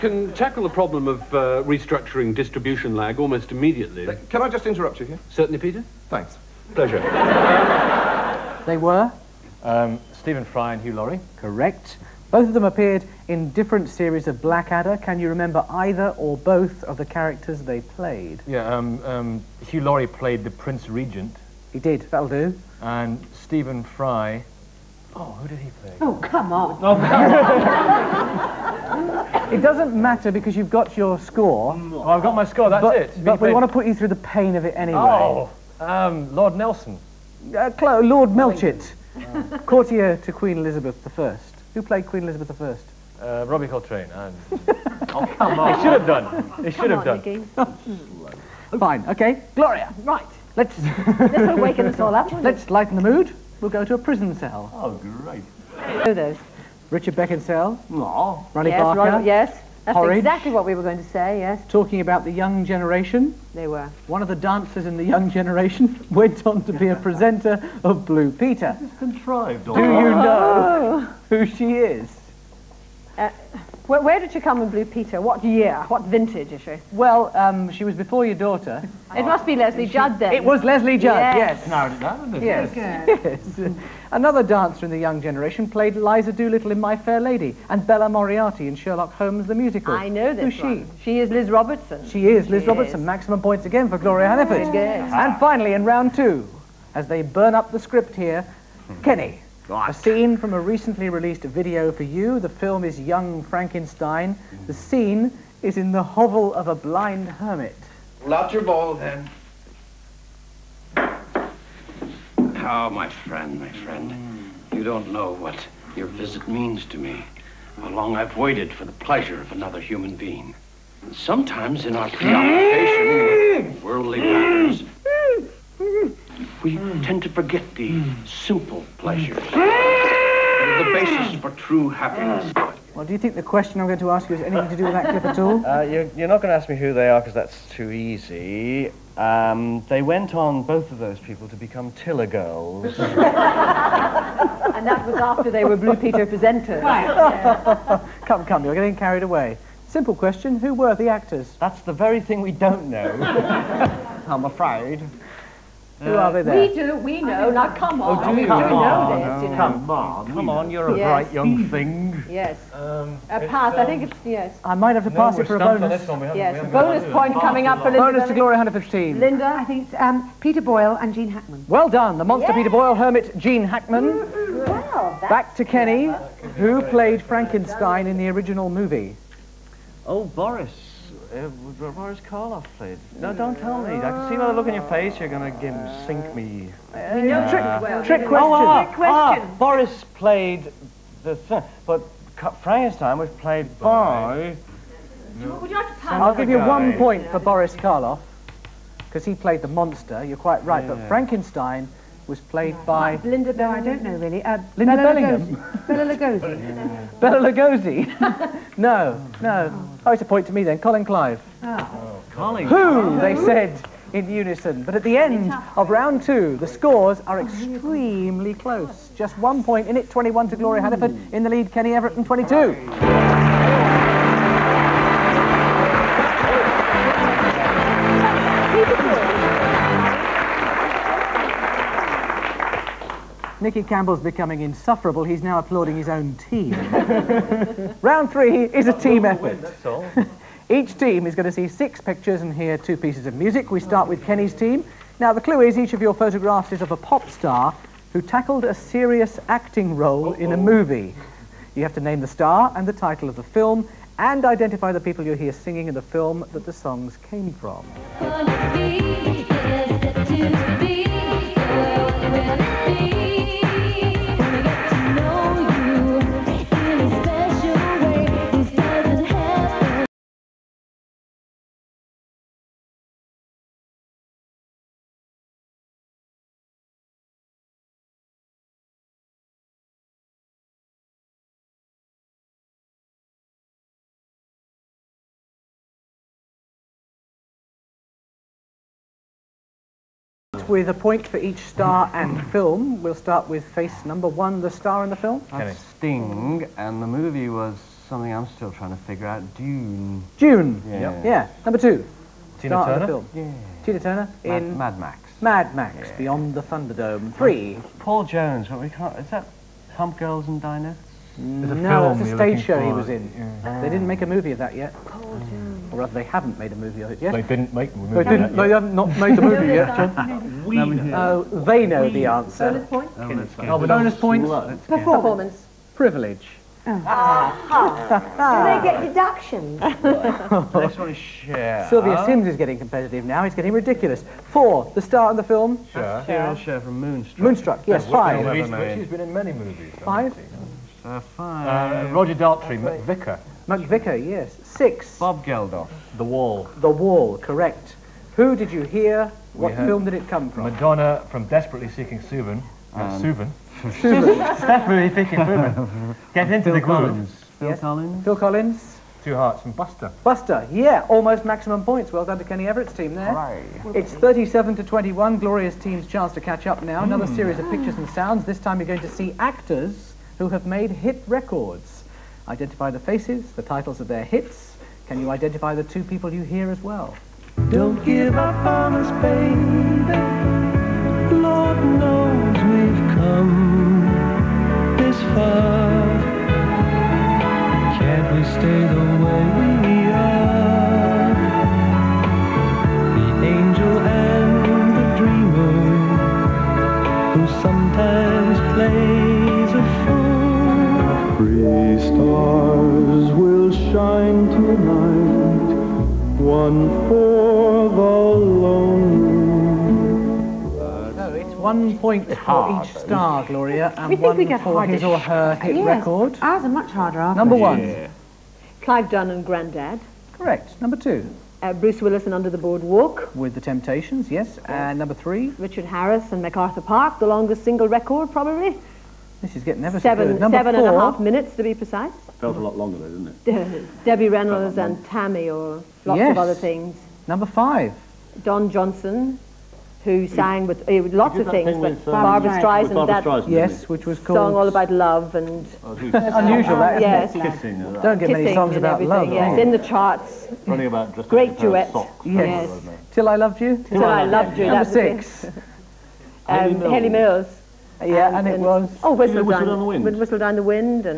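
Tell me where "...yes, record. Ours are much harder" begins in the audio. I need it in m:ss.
6:55.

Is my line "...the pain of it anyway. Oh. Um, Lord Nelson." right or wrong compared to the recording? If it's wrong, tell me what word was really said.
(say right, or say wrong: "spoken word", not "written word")
right.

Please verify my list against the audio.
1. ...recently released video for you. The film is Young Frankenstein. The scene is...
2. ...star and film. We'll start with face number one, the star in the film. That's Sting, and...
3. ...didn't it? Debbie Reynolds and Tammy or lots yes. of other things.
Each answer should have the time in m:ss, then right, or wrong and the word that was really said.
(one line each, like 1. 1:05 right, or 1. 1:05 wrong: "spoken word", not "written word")
1. 1:40 right
2. 4:51 right
3. 7:13 right.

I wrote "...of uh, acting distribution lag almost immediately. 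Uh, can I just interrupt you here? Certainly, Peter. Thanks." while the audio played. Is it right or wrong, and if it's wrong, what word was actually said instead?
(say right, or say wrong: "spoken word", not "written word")
wrong: "restructuring", not "acting".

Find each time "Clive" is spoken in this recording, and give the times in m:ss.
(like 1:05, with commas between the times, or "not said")
3:31, 6:58.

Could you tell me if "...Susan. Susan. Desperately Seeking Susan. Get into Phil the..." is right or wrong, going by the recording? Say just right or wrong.
right.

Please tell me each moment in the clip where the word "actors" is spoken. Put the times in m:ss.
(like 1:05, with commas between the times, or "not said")
2:31, 6:09.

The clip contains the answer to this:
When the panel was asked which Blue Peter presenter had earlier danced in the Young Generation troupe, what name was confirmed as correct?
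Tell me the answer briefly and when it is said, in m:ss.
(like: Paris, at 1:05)
Leslie Judd, at 1:20.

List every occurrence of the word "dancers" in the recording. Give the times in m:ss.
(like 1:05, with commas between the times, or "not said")
1:04, 1:24.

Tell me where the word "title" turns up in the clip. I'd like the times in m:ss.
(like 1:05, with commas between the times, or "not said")
4:13, 6:13.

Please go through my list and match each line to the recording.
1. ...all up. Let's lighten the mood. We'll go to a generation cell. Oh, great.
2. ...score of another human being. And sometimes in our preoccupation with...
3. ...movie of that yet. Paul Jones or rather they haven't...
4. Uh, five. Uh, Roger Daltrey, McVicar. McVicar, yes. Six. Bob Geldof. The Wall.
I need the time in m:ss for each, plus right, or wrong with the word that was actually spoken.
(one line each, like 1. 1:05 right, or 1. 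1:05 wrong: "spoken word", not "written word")
1. 0:51 wrong: "prison", not "generation"
2. 1:58 wrong: "pleasure", not "score"
3. 5:14 right
4. 5:41 right.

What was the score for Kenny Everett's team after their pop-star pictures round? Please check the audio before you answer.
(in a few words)
37.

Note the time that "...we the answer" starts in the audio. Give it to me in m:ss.
5:22.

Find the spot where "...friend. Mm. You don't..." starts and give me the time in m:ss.
1:53.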